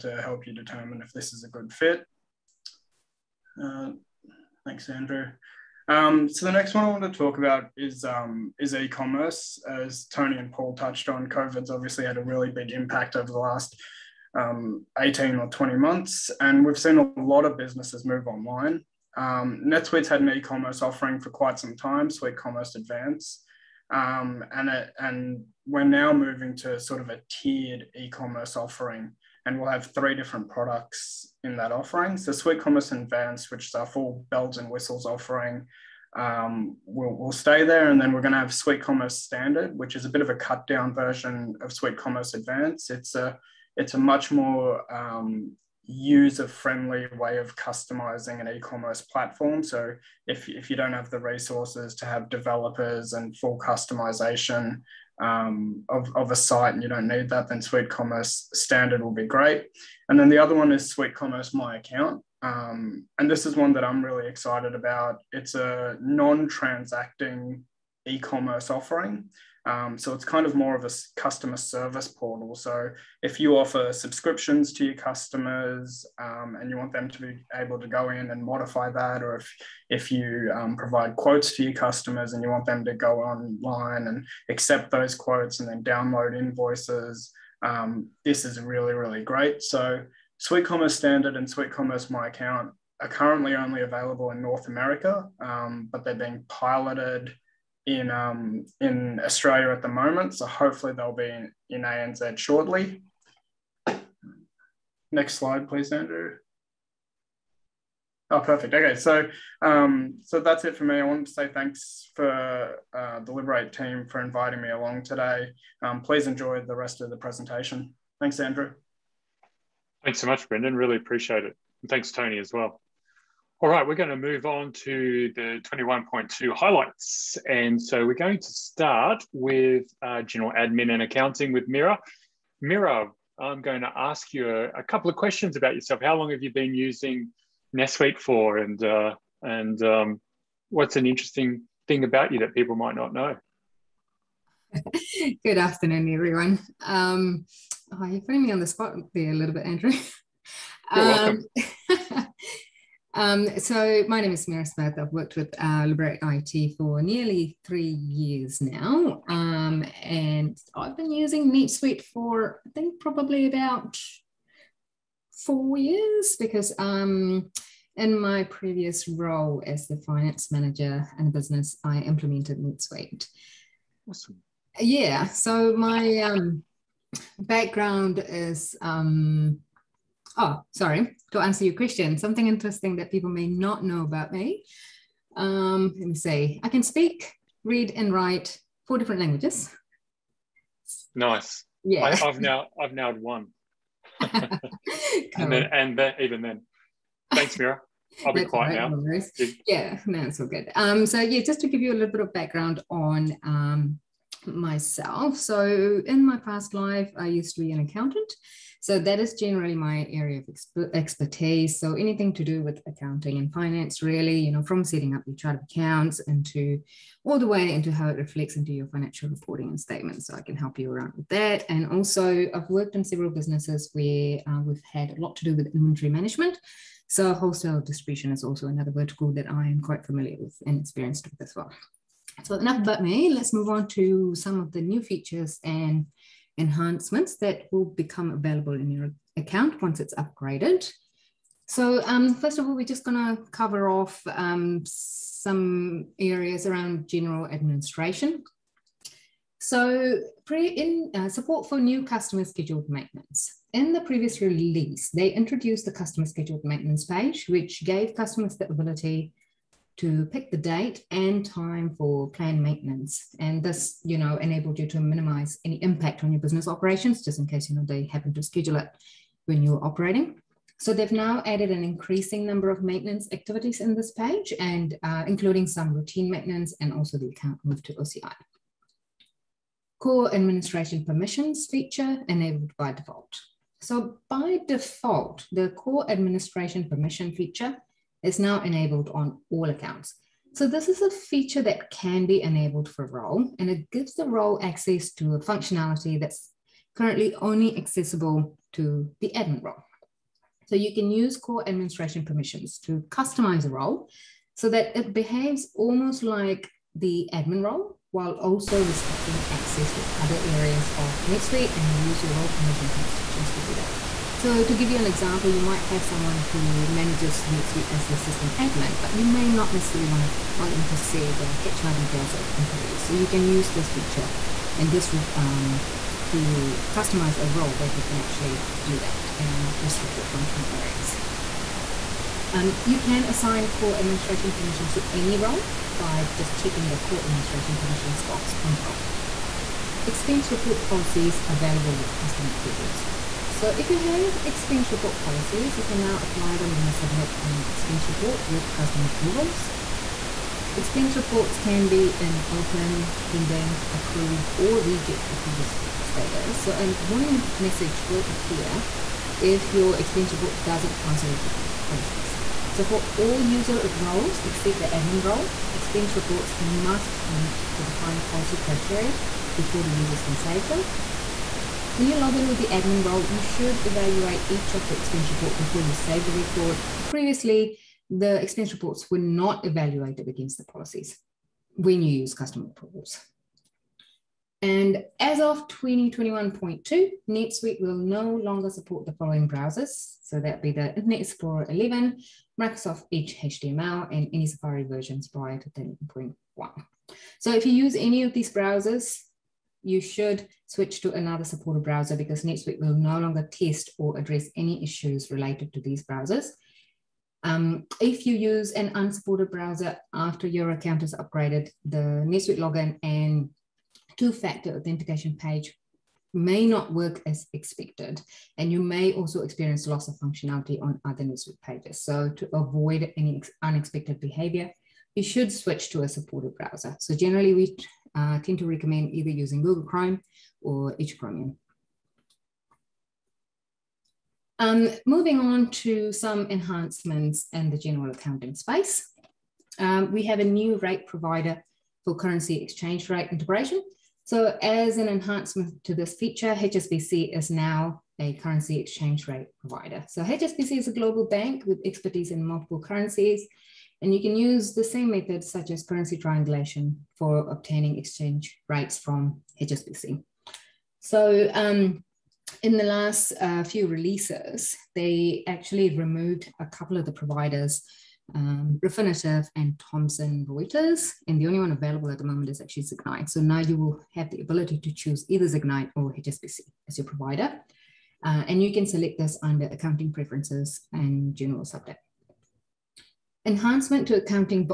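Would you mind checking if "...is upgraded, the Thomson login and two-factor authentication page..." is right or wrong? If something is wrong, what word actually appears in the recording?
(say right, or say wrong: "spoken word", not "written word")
wrong: "NetSuite", not "Thomson".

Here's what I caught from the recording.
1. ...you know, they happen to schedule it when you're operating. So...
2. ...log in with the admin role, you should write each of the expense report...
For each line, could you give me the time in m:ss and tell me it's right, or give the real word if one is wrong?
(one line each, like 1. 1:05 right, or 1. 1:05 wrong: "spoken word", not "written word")
1. 4:27 right
2. 6:12 wrong: "evaluate", not "write".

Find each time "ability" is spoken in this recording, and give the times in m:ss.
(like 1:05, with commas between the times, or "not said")
4:18, 7:54.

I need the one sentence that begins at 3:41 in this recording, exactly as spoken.
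And also, I've worked in several businesses where uh, we've had a lot to do with inventory management.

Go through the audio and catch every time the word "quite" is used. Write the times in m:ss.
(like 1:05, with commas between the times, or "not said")
0:21, 3:49.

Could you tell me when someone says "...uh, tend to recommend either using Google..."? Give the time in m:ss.
7:08.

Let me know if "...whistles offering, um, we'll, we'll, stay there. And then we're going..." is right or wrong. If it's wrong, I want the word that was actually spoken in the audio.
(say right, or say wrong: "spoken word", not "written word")
right.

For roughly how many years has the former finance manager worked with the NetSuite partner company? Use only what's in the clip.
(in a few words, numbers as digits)
nearly 3 years.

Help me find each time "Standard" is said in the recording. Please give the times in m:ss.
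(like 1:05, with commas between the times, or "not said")
0:39, 0:58, 1:30.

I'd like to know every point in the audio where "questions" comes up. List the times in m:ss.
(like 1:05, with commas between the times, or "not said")
2:15, 3:01.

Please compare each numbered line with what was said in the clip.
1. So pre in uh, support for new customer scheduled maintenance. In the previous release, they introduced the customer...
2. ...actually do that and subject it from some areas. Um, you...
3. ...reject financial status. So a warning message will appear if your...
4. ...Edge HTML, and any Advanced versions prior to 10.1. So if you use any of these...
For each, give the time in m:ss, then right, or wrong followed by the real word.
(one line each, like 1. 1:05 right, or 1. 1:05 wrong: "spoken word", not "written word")
1. 4:09 right
2. 5:28 wrong: "restrict", not "subject"
3. 5:54 wrong: "approval", not "financial"
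4. 6:33 wrong: "Safari", not "Advanced".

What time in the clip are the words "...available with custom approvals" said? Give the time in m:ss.
5:41.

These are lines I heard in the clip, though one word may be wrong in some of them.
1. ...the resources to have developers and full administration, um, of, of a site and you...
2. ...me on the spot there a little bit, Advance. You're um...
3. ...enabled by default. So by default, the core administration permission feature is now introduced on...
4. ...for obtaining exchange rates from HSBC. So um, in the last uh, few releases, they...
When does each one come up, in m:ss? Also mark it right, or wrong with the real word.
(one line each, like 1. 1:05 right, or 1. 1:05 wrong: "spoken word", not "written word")
1. 0:51 wrong: "customization", not "administration"
2. 2:28 wrong: "Andrew", not "Advance"
3. 4:42 wrong: "enabled", not "introduced"
4. 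7:37 right.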